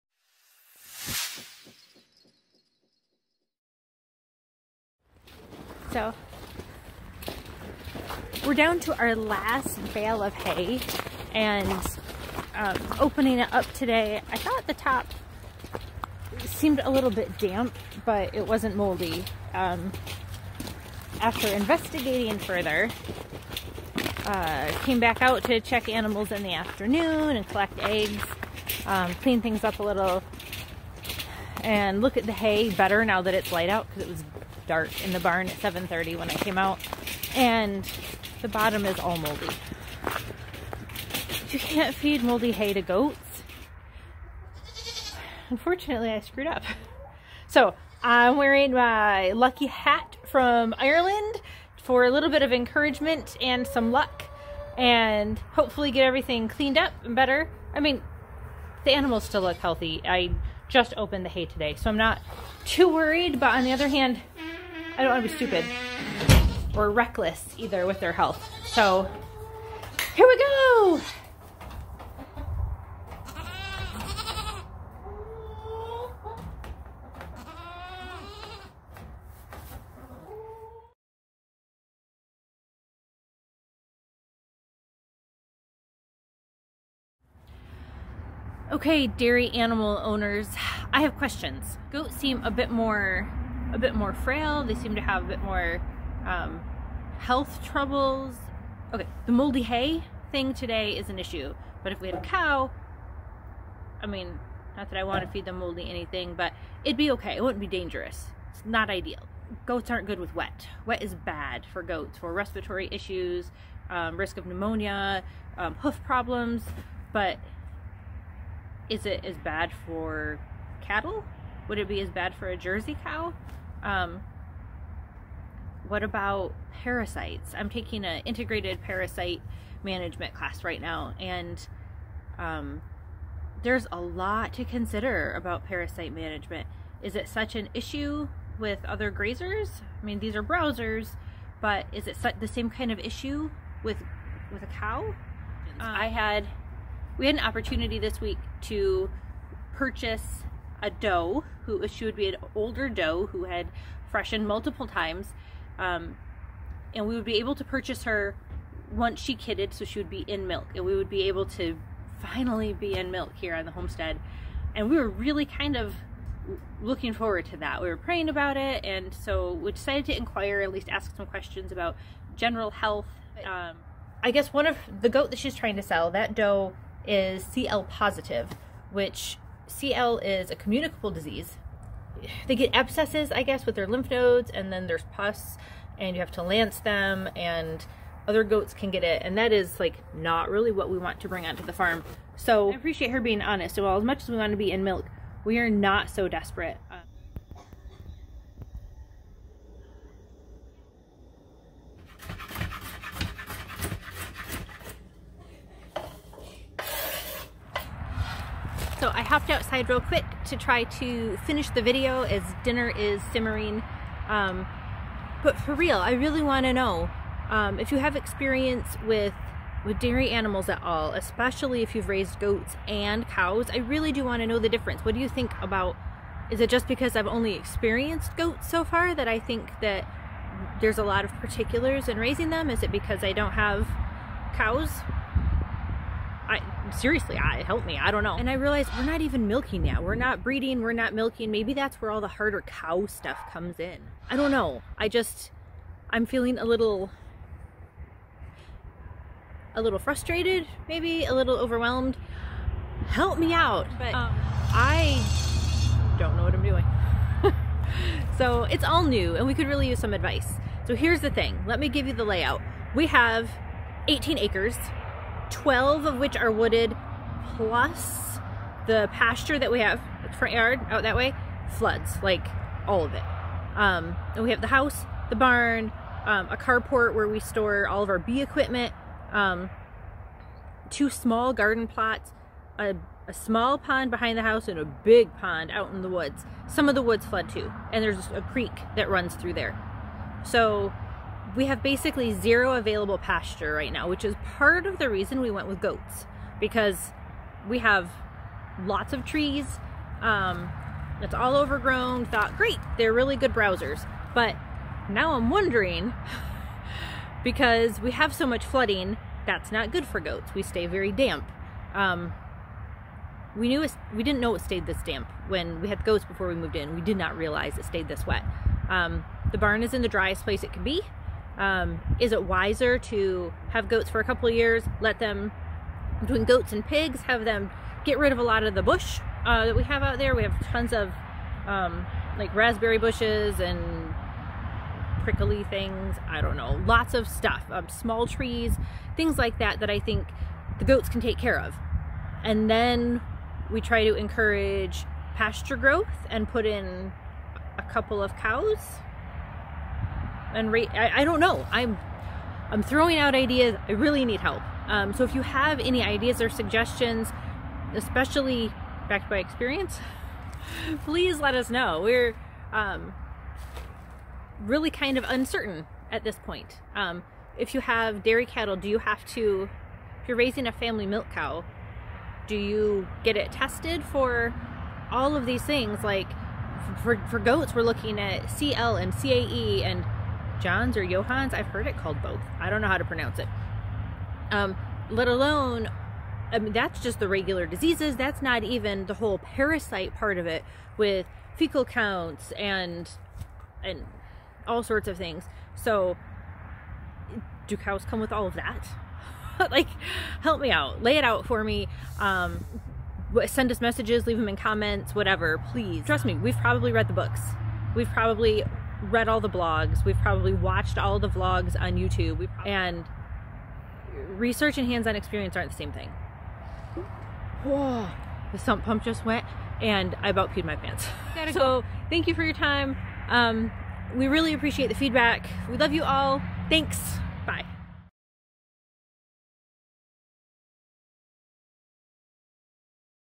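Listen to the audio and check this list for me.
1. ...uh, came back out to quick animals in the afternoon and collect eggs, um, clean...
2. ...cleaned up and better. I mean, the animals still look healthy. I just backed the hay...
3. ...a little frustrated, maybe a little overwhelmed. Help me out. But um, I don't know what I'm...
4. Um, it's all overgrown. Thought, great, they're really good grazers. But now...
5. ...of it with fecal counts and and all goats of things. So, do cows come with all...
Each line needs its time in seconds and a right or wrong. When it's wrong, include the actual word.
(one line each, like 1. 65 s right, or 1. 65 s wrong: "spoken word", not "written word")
1. 24 s wrong: "check", not "quick"
2. 56 s wrong: "opened", not "backed"
3. 249 s right
4. 300 s wrong: "browsers", not "grazers"
5. 390 s wrong: "sorts", not "goats".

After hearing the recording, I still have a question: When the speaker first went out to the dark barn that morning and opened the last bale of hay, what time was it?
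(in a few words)
7:30.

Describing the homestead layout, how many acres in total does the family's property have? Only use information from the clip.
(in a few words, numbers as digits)
18.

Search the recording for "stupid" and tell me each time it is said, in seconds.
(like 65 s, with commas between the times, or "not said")
65 s.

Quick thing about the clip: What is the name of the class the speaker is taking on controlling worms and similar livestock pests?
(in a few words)
Integrated parasite management.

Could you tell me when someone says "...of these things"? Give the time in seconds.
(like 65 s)
375 s.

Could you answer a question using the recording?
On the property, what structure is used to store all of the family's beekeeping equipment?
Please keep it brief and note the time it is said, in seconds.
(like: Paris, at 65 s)
A carport, at 276 s.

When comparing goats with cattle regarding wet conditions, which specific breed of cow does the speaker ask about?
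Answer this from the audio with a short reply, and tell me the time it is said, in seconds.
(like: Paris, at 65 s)
Jersey, at 122 s.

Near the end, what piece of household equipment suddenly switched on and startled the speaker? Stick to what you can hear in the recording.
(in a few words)
The sump pump.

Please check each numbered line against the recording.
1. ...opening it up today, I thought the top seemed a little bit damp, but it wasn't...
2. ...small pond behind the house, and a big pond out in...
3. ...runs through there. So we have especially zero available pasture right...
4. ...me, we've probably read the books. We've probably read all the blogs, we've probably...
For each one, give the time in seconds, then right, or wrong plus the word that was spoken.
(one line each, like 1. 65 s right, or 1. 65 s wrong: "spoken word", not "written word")
1. 12 s right
2. 283 s right
3. 289 s wrong: "basically", not "especially"
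4. 406 s right.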